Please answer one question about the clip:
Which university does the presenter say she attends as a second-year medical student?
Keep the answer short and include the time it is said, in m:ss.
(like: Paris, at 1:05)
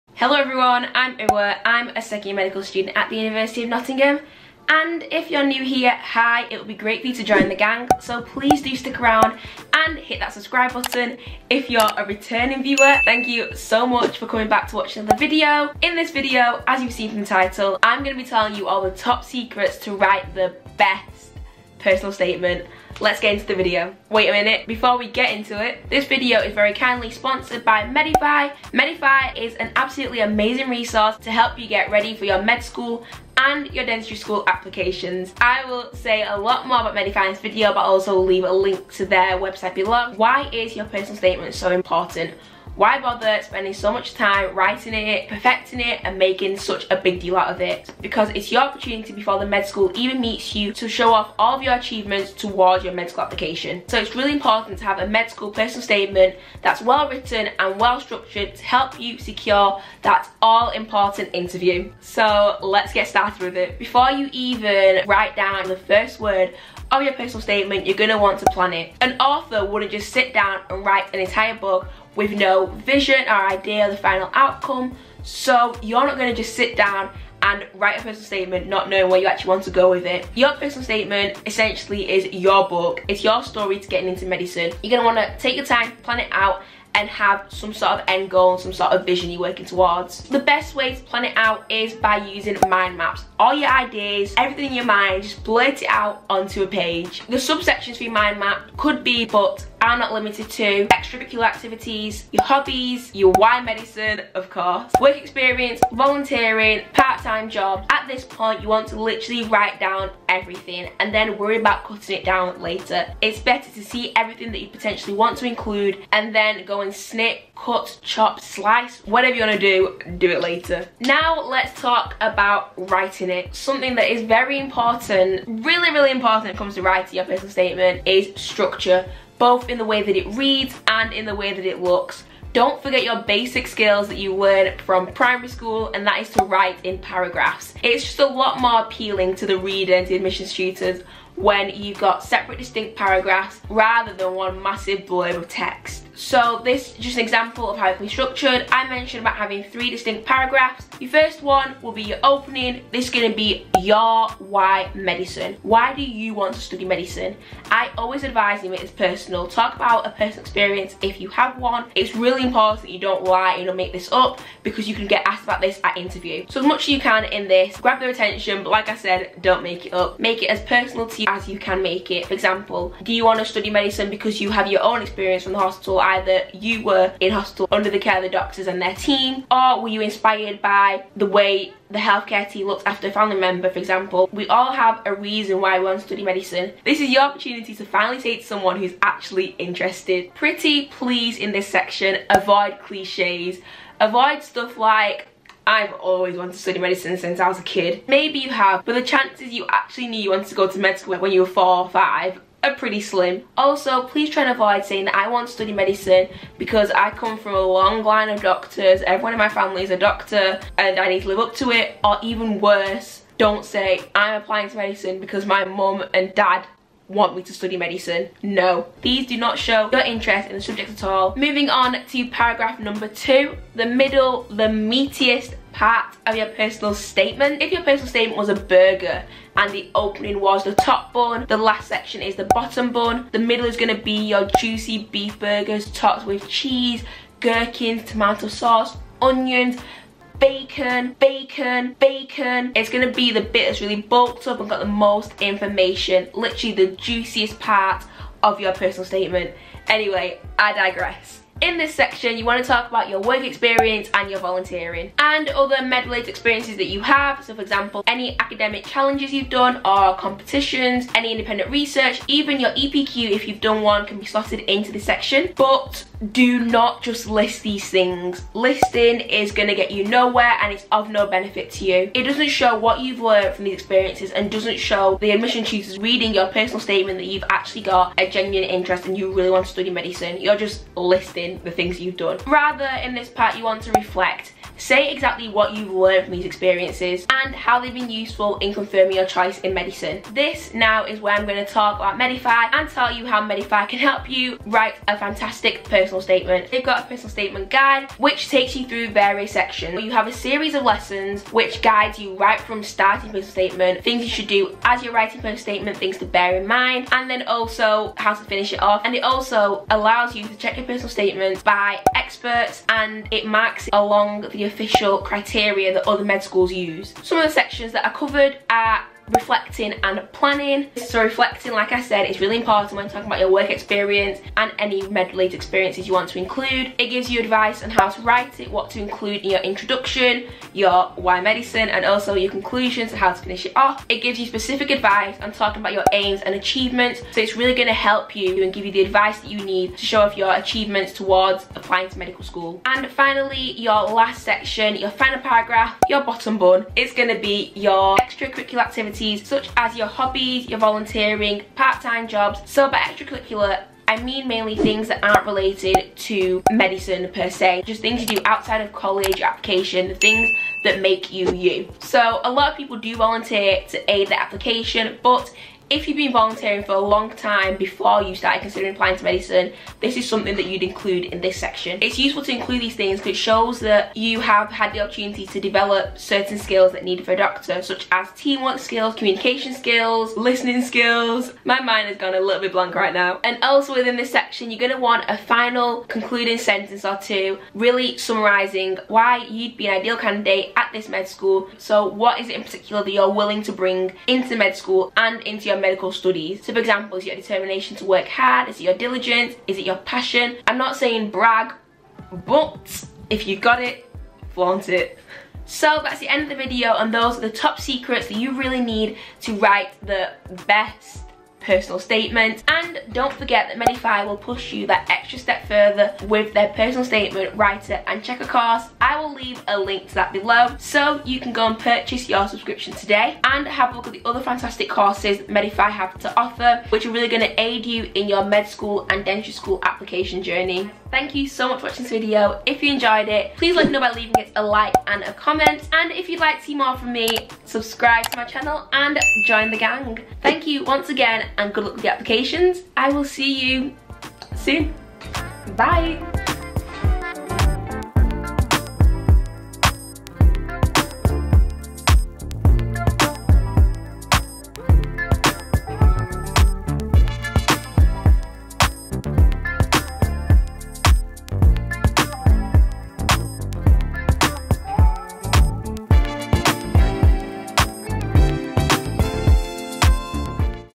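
University of Nottingham, at 0:03.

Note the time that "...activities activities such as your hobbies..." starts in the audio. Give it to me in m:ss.
5:48.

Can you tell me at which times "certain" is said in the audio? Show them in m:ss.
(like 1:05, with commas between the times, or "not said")
6:16.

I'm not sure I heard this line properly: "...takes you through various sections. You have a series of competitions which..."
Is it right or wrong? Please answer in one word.
wrong.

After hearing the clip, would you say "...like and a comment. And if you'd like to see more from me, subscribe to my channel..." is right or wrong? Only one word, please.
right.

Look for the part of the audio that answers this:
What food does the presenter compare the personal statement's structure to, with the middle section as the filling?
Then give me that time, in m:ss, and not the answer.
3:48.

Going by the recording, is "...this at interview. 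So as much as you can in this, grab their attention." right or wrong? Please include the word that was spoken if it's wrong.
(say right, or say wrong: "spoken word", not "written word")
right.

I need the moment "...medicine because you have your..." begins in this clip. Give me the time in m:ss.
2:53.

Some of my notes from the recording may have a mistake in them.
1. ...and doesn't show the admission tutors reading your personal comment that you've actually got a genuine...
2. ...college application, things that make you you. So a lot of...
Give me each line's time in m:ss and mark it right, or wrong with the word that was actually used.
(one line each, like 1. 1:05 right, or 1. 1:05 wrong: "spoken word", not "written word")
1. 4:34 wrong: "statement", not "comment"
2. 5:58 right.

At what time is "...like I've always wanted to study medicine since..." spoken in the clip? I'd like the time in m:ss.
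3:14.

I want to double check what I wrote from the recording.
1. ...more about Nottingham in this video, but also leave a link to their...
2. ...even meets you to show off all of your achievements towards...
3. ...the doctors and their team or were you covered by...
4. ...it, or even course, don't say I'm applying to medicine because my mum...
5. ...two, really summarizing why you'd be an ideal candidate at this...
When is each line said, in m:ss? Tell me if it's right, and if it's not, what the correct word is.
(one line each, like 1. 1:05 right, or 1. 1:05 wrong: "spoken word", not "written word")
1. 0:36 wrong: "Medify", not "Nottingham"
2. 0:49 right
3. 2:58 wrong: "inspired", not "covered"
4. 3:31 wrong: "worse", not "course"
5. 6:27 right.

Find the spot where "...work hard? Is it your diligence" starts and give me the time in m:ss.
6:38.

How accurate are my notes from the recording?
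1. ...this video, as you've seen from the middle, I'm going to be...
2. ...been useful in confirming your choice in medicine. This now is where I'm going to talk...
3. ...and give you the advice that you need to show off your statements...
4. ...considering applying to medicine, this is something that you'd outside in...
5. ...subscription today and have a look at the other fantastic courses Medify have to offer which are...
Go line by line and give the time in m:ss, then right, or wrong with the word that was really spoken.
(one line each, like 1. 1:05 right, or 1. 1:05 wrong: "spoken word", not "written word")
1. 0:15 wrong: "title", not "middle"
2. 4:47 right
3. 5:38 wrong: "achievements", not "statements"
4. 6:08 wrong: "include", not "outside"
5. 7:02 right.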